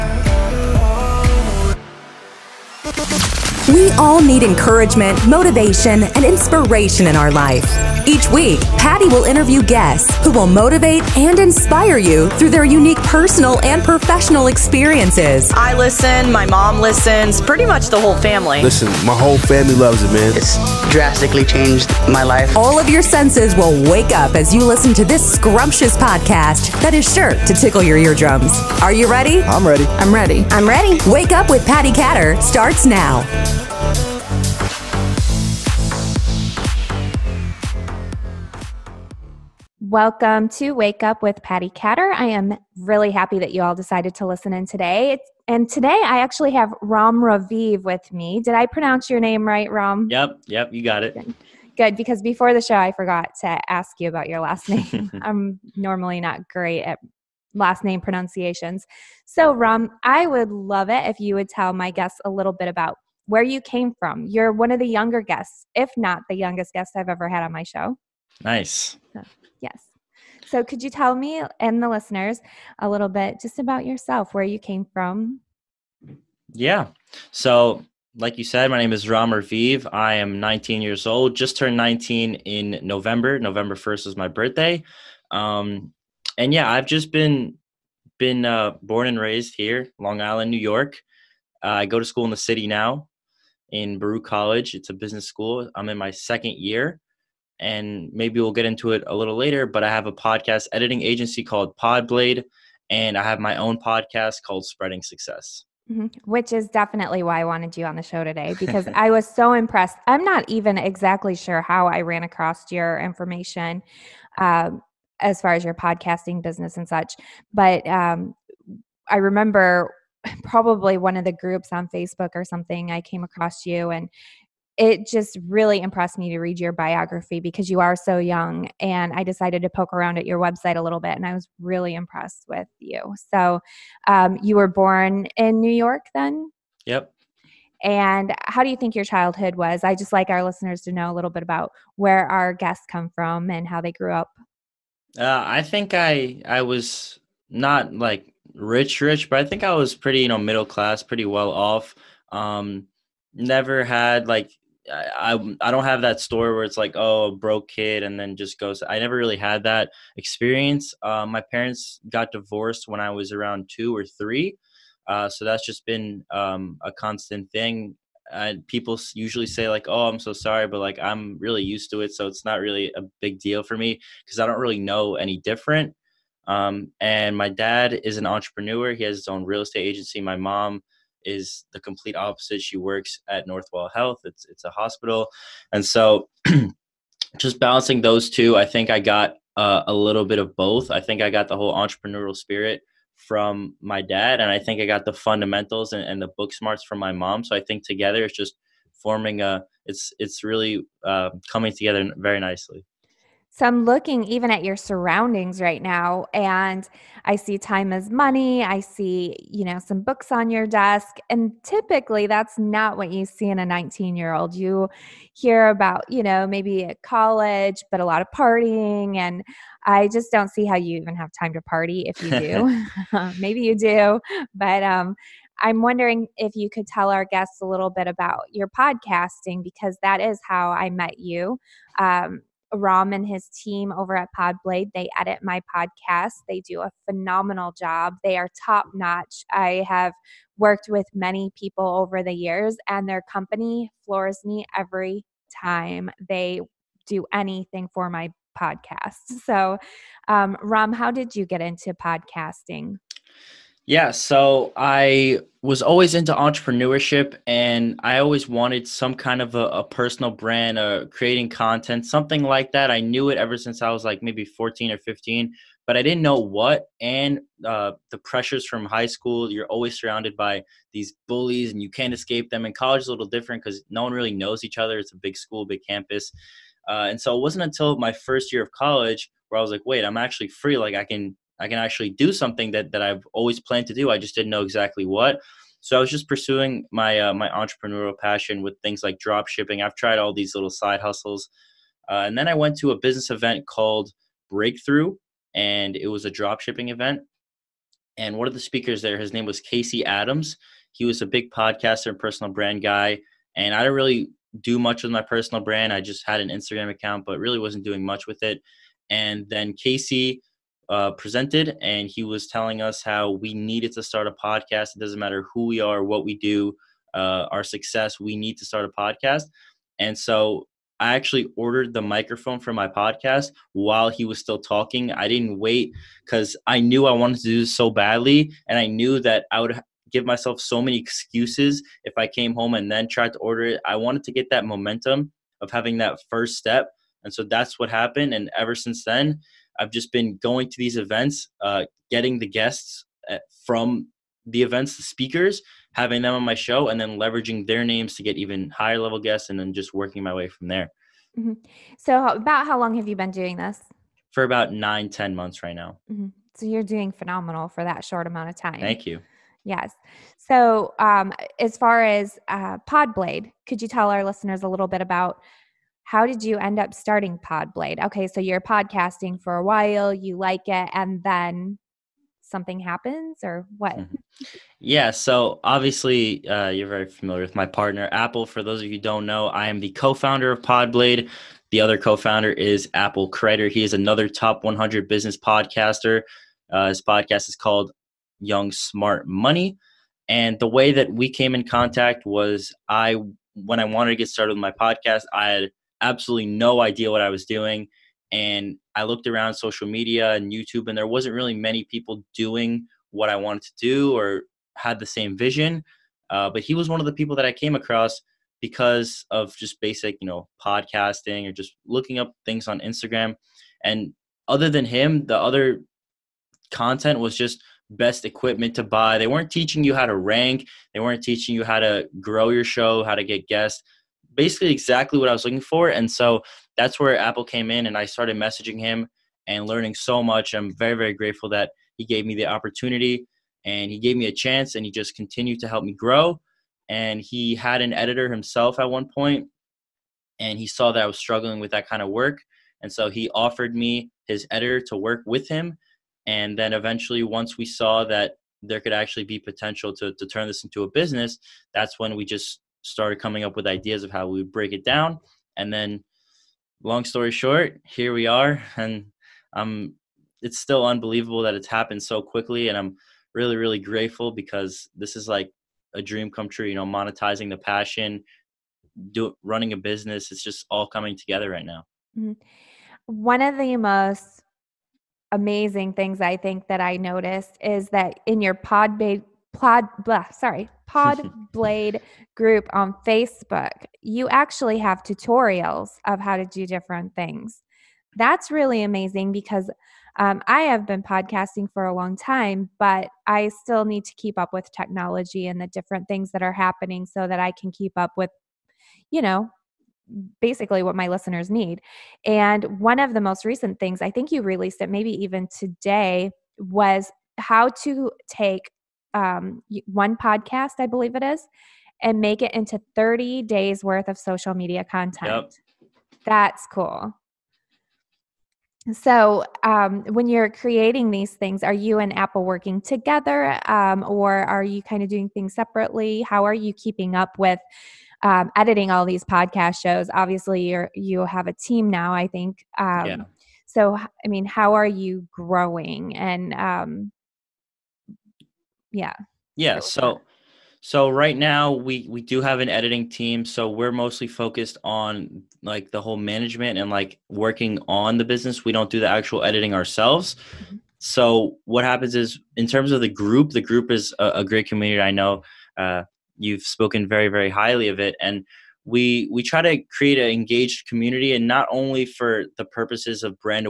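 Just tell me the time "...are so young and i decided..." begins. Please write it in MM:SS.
02:07.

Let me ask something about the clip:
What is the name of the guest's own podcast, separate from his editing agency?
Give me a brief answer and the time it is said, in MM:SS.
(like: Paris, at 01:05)
Spreading Success, at 01:44.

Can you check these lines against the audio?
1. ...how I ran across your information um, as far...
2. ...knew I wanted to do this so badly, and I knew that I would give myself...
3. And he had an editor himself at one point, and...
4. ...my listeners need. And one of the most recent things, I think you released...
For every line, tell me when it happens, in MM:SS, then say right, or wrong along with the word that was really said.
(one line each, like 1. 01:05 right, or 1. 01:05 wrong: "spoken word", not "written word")
1. 01:51 right
2. 05:26 right
3. 07:16 right
4. 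08:20 right.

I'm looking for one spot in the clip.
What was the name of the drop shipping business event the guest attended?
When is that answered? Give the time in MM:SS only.
04:54.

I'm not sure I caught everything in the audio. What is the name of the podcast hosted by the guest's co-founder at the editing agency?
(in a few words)
Young Smart Money.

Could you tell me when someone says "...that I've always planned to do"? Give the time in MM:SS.
04:42.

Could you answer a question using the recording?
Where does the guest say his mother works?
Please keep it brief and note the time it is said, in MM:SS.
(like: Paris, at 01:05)
Northwell Health, at 03:03.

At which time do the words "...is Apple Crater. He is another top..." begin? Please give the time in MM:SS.
06:22.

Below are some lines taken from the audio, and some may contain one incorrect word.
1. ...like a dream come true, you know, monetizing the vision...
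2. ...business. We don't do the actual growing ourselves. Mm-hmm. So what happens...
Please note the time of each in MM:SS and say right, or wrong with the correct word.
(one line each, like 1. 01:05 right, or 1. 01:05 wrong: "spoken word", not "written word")
1. 07:45 wrong: "passion", not "vision"
2. 09:08 wrong: "editing", not "growing".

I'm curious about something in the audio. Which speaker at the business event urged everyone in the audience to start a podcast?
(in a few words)
Casey Adams.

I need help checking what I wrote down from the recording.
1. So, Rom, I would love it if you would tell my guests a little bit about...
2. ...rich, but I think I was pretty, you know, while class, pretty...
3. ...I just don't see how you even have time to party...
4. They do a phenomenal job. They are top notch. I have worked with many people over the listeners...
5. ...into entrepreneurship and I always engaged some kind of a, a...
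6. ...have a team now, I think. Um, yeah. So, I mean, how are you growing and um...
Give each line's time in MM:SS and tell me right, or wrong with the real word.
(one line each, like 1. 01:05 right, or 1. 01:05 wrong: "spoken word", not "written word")
1. 00:59 right
2. 02:29 wrong: "middle", not "while"
3. 03:39 right
4. 03:56 wrong: "years", not "listeners"
5. 04:16 wrong: "wanted", not "engaged"
6. 08:51 right.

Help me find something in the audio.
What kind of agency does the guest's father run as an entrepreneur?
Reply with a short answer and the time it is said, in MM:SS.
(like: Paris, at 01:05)
real estate agency, at 02:59.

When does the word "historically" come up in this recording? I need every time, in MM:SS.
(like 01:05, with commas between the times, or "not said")
not said.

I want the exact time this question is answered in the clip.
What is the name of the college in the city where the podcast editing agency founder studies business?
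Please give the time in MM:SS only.
01:33.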